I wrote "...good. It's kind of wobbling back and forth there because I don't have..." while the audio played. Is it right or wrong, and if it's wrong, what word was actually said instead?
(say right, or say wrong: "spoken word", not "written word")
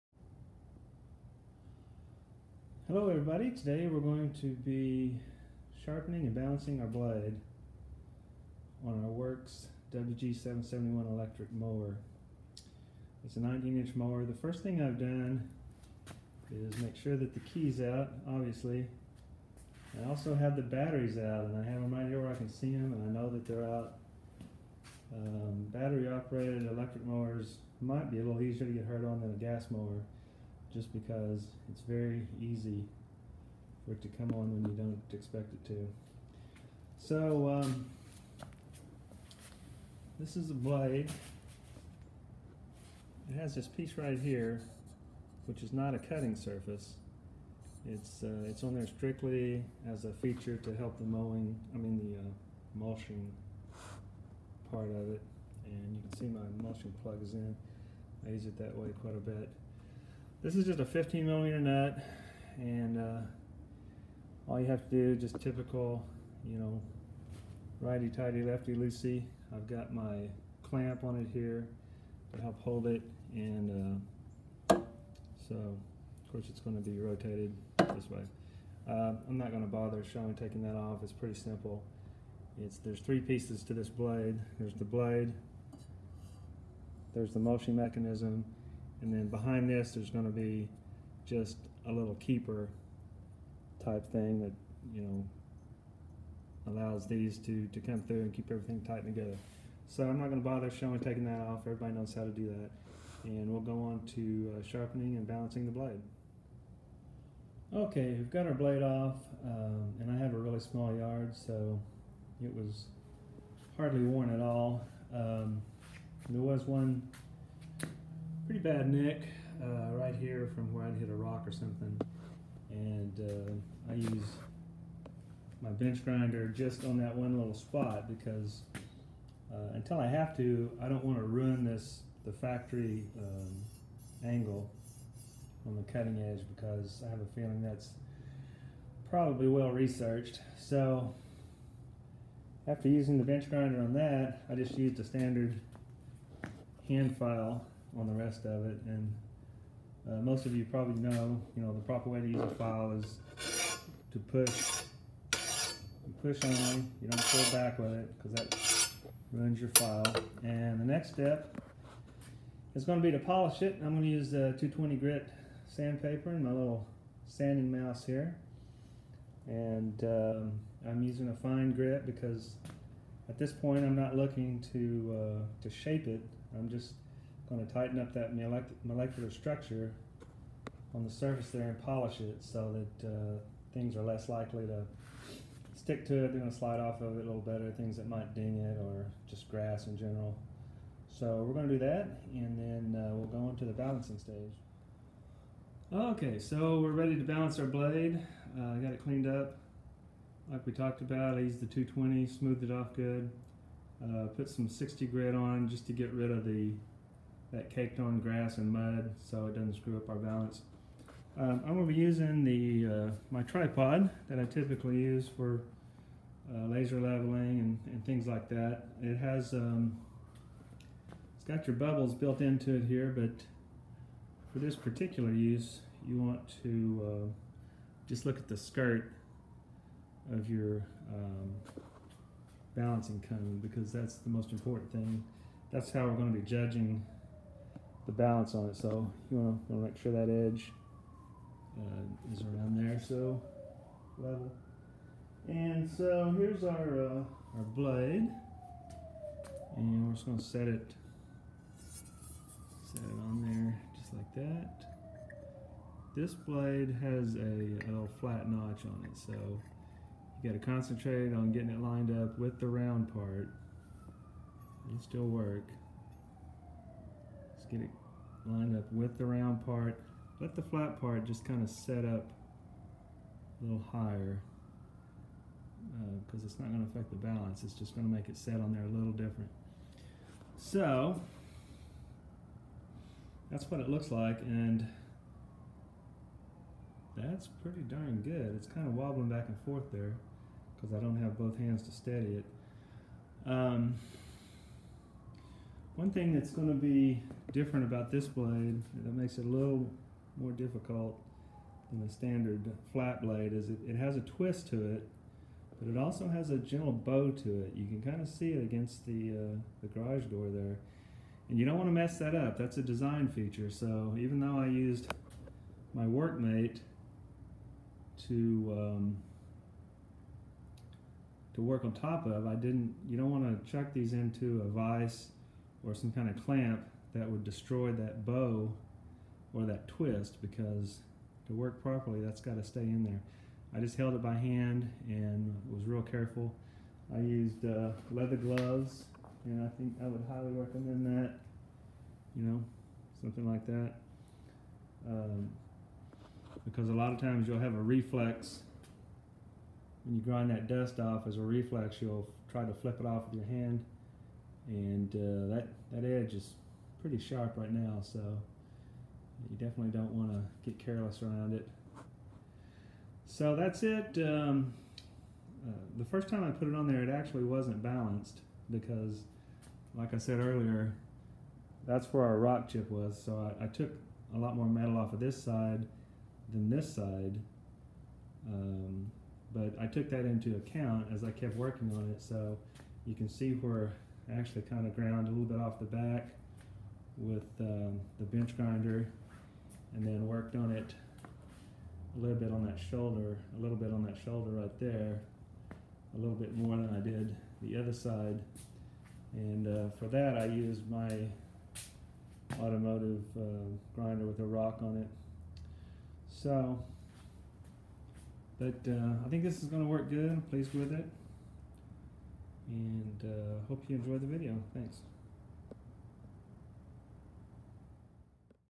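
right.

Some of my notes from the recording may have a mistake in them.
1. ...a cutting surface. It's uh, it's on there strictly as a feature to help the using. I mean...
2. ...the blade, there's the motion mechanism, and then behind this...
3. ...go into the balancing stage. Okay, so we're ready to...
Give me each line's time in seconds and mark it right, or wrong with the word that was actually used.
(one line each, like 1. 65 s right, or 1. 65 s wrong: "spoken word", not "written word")
1. 45 s wrong: "mowing", not "using"
2. 84 s right
3. 193 s right.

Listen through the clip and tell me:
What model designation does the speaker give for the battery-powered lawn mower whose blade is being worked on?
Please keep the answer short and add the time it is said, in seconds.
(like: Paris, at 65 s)
Worx WG771, at 9 s.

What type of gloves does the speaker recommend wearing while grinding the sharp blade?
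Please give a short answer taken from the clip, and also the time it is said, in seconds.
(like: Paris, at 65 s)
leather gloves, at 338 s.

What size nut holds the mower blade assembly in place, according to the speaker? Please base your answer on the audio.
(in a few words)
15 millimeter.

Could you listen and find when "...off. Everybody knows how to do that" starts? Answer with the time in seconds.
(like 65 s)
101 s.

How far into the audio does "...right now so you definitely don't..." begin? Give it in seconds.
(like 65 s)
357 s.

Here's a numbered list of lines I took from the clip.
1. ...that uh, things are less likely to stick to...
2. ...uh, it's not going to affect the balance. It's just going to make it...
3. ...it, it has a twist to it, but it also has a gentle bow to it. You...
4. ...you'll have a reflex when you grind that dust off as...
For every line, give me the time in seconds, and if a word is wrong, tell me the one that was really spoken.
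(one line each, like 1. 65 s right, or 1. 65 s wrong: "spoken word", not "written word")
1. 182 s right
2. 276 s right
3. 303 s right
4. 347 s right.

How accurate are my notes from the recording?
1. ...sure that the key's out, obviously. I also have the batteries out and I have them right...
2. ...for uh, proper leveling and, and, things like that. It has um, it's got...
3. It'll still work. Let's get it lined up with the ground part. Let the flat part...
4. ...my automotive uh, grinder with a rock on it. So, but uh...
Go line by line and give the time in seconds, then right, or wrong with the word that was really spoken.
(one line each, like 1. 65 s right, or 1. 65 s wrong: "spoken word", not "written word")
1. 16 s right
2. 215 s wrong: "laser", not "proper"
3. 264 s wrong: "round", not "ground"
4. 400 s right.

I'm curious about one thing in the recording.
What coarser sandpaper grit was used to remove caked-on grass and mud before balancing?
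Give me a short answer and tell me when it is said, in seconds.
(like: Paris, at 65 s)
60 grit, at 204 s.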